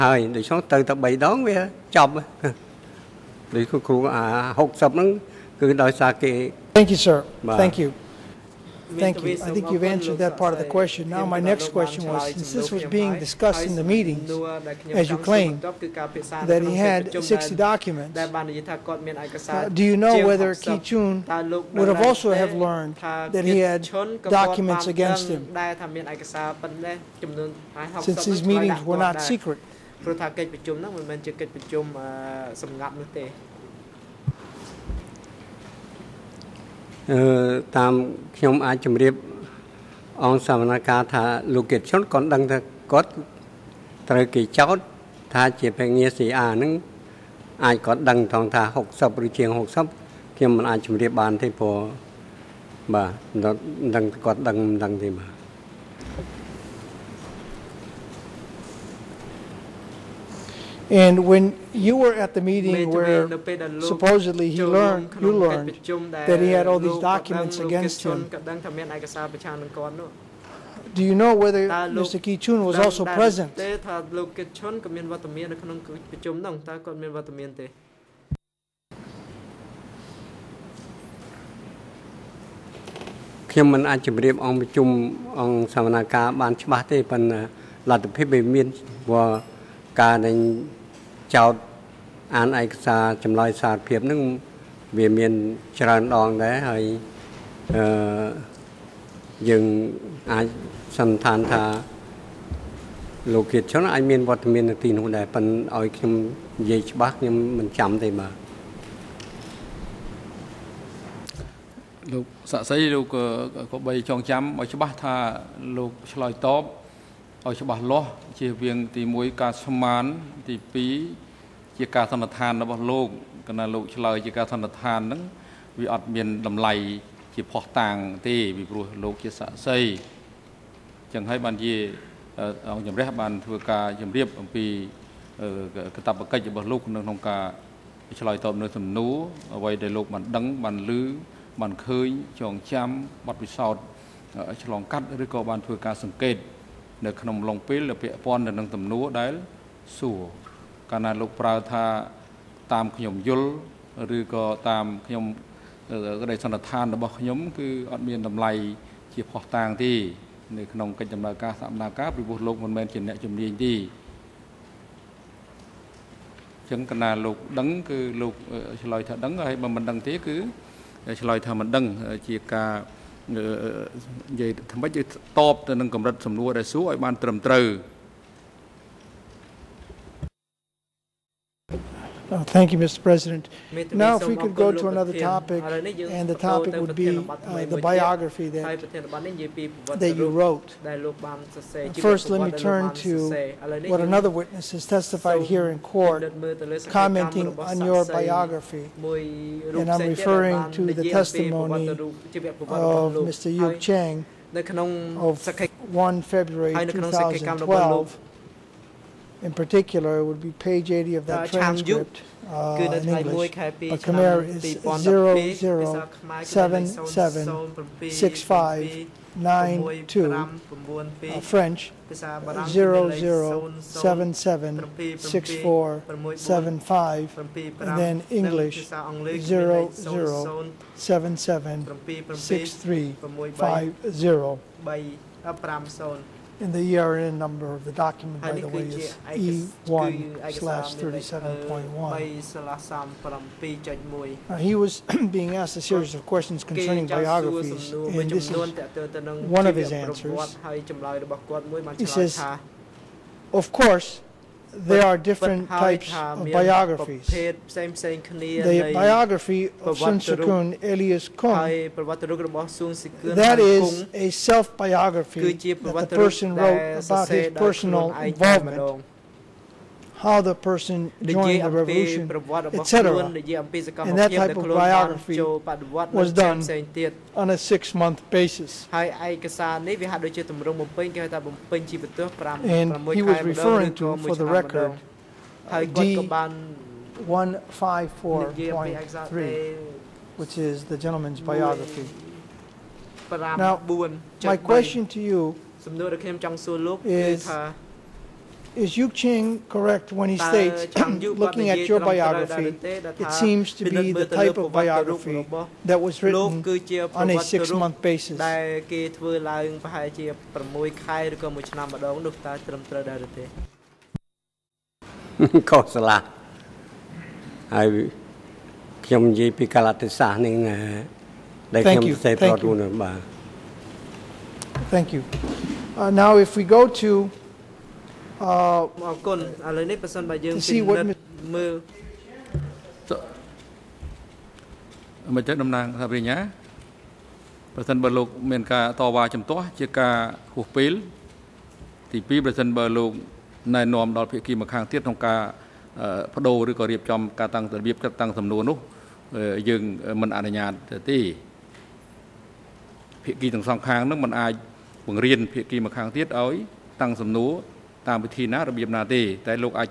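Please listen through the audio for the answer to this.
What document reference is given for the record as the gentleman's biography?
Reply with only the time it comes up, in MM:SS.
04:45.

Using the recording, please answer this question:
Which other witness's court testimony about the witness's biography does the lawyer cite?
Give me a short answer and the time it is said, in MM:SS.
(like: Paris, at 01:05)
Yuk Chang, at 03:23.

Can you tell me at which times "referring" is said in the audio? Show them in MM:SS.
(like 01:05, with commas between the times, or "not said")
03:20, 04:43.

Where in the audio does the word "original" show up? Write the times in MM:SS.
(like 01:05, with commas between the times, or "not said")
not said.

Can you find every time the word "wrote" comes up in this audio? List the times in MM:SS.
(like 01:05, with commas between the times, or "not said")
03:10, 04:26.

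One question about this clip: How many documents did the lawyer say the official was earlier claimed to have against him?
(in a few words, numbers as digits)
60.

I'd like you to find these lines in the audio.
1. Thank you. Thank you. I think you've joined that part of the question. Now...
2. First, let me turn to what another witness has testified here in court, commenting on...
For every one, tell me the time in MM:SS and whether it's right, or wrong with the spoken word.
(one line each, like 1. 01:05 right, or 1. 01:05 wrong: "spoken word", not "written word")
1. 00:07 wrong: "answered", not "joined"
2. 03:12 right.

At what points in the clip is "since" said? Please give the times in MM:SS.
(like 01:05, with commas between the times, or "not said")
00:12, 00:28.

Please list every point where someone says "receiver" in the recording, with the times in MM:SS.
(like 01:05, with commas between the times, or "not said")
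not said.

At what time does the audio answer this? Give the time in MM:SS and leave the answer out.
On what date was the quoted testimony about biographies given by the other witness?
03:26.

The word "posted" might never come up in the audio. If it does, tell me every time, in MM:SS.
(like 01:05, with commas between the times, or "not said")
not said.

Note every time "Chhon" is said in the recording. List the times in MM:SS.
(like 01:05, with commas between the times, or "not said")
00:20, 01:12.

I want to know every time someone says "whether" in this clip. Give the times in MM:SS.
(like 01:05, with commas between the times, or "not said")
00:20, 01:11.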